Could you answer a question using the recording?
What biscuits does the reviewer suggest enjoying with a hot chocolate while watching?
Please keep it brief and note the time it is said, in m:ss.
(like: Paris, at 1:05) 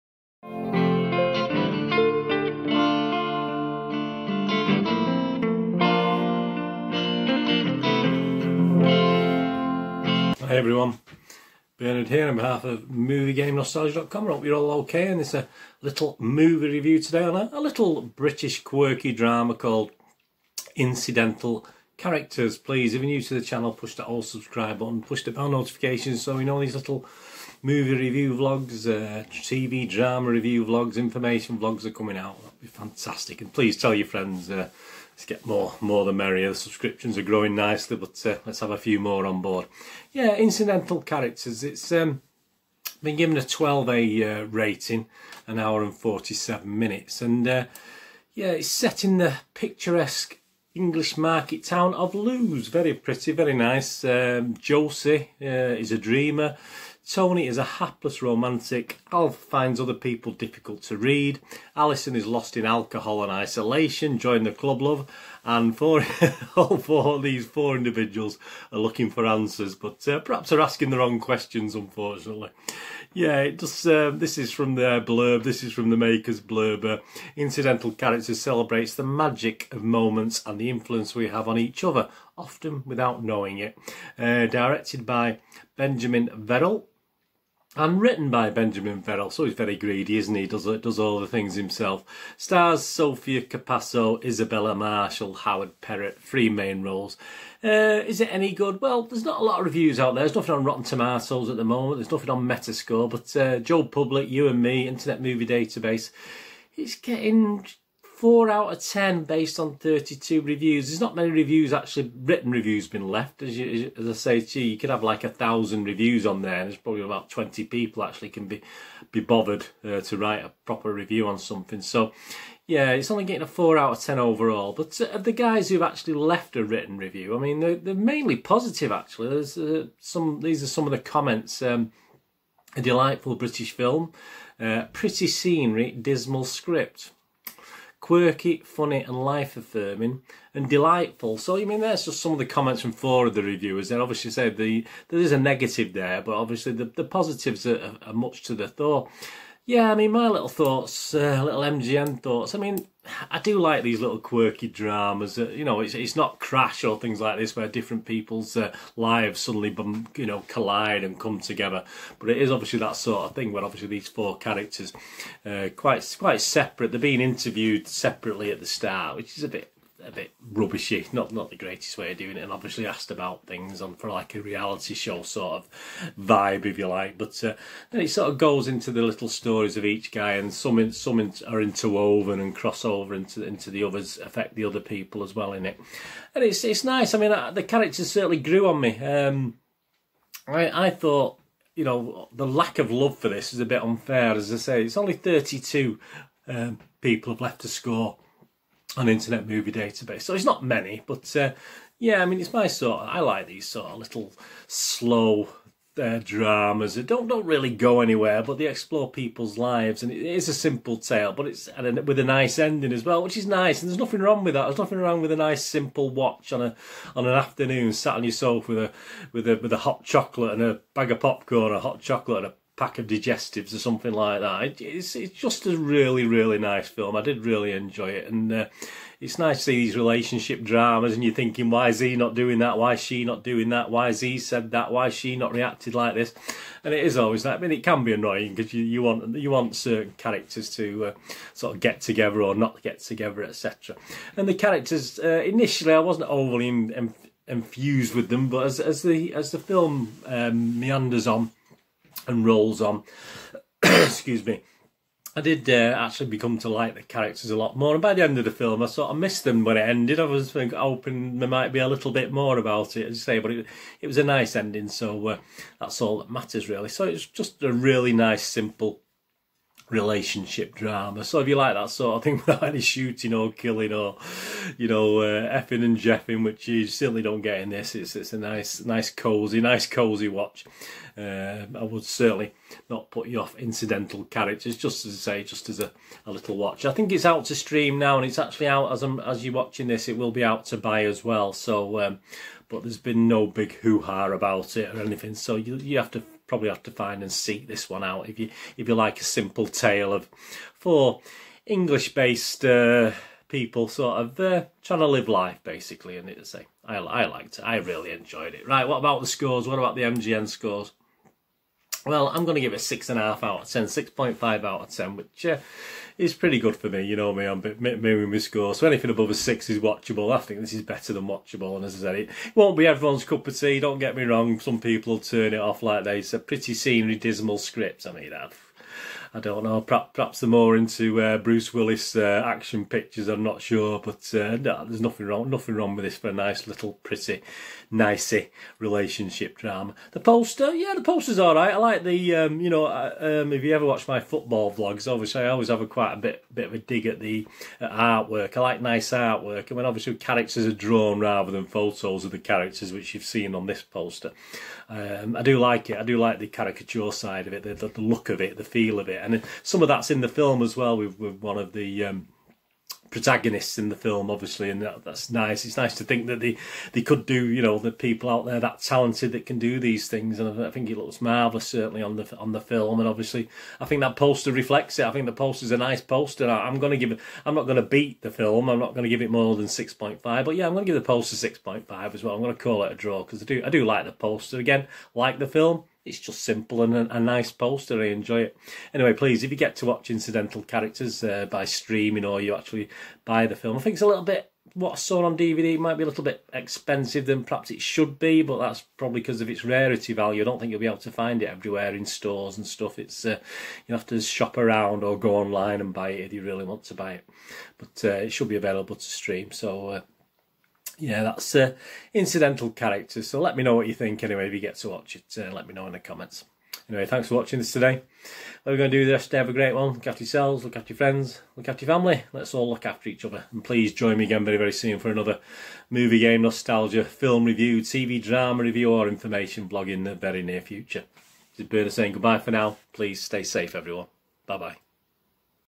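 digestives, at 3:43.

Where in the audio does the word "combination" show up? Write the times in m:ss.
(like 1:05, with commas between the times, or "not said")
not said.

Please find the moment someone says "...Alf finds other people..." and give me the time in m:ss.
0:59.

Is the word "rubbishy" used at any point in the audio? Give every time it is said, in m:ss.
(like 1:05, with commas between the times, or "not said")
2:50.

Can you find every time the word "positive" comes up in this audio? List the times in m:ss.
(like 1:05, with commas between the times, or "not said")
2:08, 2:27.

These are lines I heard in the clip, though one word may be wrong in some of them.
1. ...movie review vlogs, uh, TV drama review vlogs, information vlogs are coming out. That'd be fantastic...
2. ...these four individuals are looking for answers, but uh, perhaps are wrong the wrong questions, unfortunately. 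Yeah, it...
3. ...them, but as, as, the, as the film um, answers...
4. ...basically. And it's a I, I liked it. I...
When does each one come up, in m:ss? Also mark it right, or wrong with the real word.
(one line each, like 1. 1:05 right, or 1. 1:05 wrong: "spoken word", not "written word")
1. 0:27 right
2. 1:07 wrong: "asking", not "wrong"
3. 4:08 wrong: "meanders", not "answers"
4. 5:05 right.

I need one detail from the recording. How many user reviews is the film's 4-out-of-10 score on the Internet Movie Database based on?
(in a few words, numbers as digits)
32.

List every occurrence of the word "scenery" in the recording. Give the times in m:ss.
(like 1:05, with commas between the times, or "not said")
2:15, 5:26.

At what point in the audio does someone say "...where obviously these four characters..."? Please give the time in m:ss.
2:43.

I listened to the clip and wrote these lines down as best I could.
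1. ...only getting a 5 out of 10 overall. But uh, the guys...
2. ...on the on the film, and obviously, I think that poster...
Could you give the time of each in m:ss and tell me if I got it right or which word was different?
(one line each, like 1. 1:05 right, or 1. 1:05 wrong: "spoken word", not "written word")
1. 2:03 wrong: "4", not "5"
2. 6:12 right.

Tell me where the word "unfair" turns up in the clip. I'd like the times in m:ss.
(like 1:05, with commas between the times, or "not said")
3:13.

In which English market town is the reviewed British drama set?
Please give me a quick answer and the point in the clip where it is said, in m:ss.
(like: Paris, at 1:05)
Lewes, at 0:52.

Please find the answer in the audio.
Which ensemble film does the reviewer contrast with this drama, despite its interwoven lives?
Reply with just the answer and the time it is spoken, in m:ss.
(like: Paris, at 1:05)
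Crash, at 2:36.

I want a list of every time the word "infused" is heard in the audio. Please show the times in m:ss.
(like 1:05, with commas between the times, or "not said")
4:07.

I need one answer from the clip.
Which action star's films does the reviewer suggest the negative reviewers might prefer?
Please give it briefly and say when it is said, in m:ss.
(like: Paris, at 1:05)
Bruce Willis, at 5:31.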